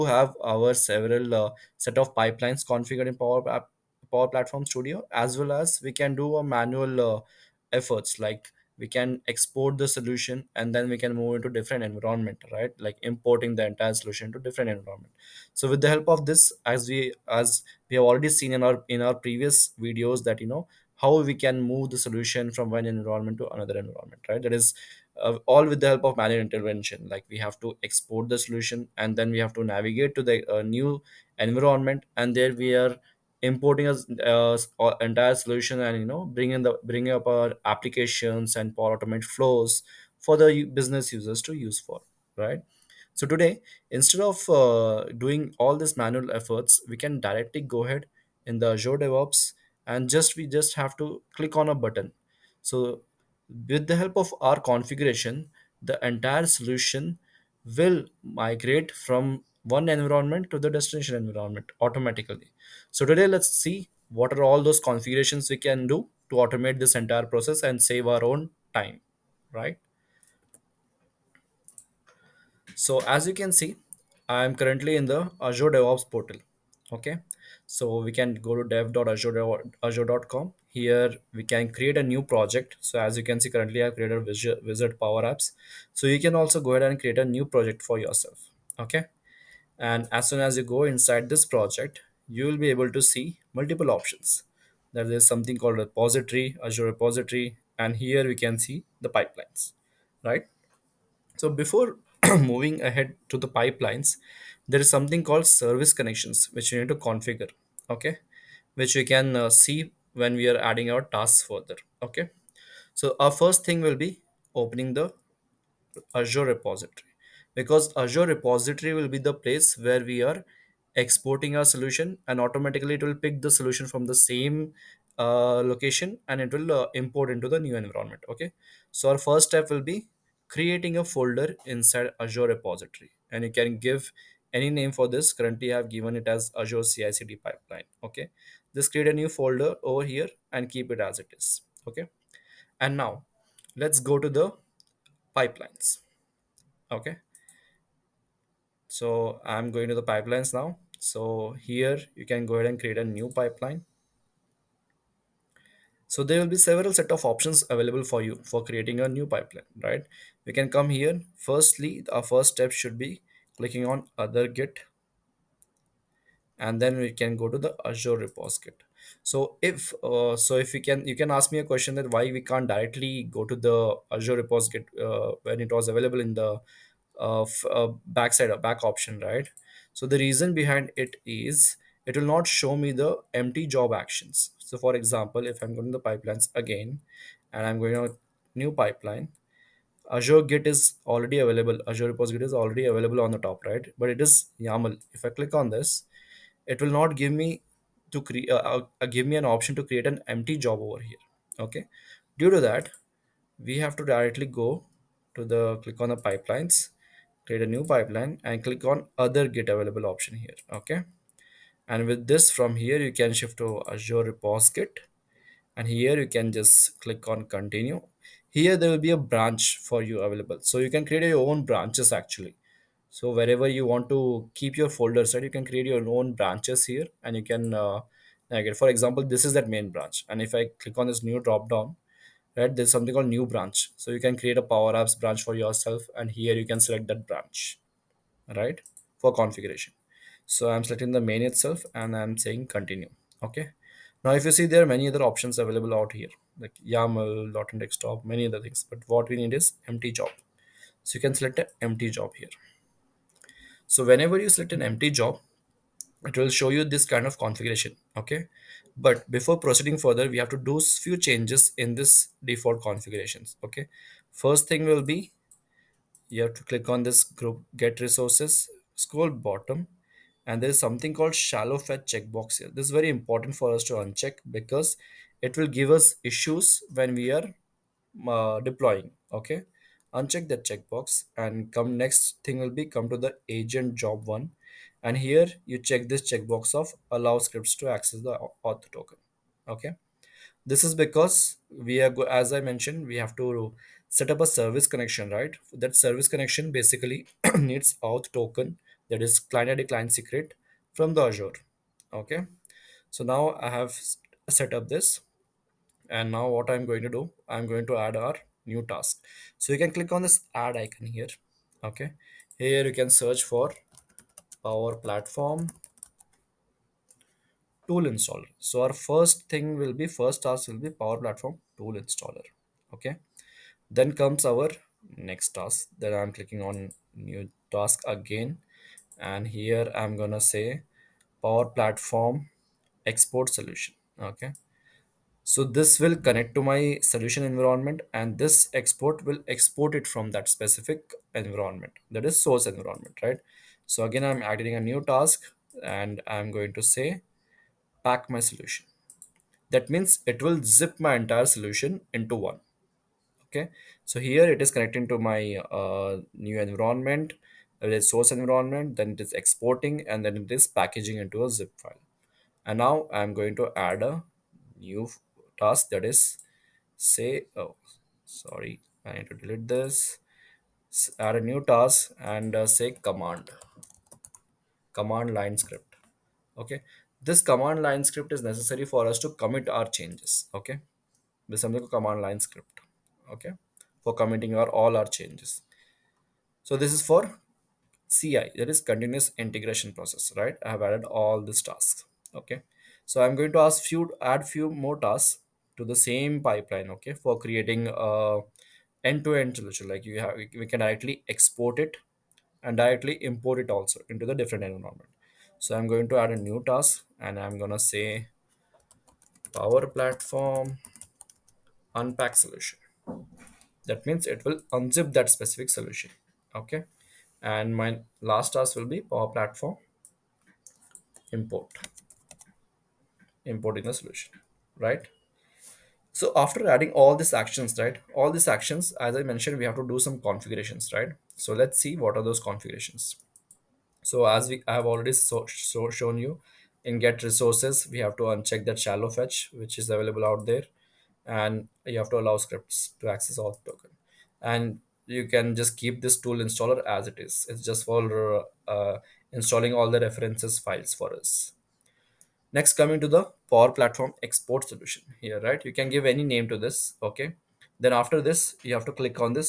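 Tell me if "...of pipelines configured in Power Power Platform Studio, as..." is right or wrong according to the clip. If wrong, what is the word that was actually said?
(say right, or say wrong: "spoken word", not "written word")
right.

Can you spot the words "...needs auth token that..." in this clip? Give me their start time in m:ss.
4:57.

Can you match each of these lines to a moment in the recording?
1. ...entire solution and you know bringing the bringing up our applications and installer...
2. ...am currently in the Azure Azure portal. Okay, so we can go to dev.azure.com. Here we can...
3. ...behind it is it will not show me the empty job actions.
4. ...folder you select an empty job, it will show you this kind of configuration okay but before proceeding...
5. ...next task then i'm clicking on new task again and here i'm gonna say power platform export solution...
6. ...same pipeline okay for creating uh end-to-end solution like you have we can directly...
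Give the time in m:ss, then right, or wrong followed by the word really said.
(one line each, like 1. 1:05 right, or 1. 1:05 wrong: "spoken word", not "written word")
1. 0:35 wrong: "power", not "installer"
2. 1:14 wrong: "DevOps", not "Azure"
3. 3:00 right
4. 4:14 wrong: "whenever", not "folder"
5. 5:25 right
6. 6:36 right.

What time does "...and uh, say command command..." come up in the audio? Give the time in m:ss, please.
6:12.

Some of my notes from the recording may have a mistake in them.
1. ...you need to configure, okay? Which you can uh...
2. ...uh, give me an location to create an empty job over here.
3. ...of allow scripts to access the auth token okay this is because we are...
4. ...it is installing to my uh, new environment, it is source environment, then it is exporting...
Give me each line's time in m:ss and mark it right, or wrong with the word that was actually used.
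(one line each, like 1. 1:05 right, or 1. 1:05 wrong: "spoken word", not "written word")
1. 1:46 right
2. 3:19 wrong: "option", not "location"
3. 4:46 right
4. 5:54 wrong: "connecting", not "installing".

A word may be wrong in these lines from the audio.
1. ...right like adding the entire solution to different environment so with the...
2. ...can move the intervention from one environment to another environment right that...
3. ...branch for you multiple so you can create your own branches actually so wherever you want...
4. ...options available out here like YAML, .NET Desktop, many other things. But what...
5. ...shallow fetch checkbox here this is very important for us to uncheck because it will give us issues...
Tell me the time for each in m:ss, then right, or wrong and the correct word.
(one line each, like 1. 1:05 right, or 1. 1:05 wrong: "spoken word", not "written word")
1. 0:12 wrong: "importing", not "adding"
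2. 0:21 wrong: "solution", not "intervention"
3. 3:39 wrong: "available", not "multiple"
4. 4:05 right
5. 4:31 right.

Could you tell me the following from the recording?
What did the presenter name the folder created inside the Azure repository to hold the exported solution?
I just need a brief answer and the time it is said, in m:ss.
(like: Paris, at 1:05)
azure cicd pipeline, at 2:16.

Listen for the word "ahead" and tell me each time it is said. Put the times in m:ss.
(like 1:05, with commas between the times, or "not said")
0:47, 1:26, 1:42, 2:32.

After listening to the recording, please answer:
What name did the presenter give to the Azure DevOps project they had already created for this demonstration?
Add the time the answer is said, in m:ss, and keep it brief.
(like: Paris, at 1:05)
Wizard Power Apps, at 1:24.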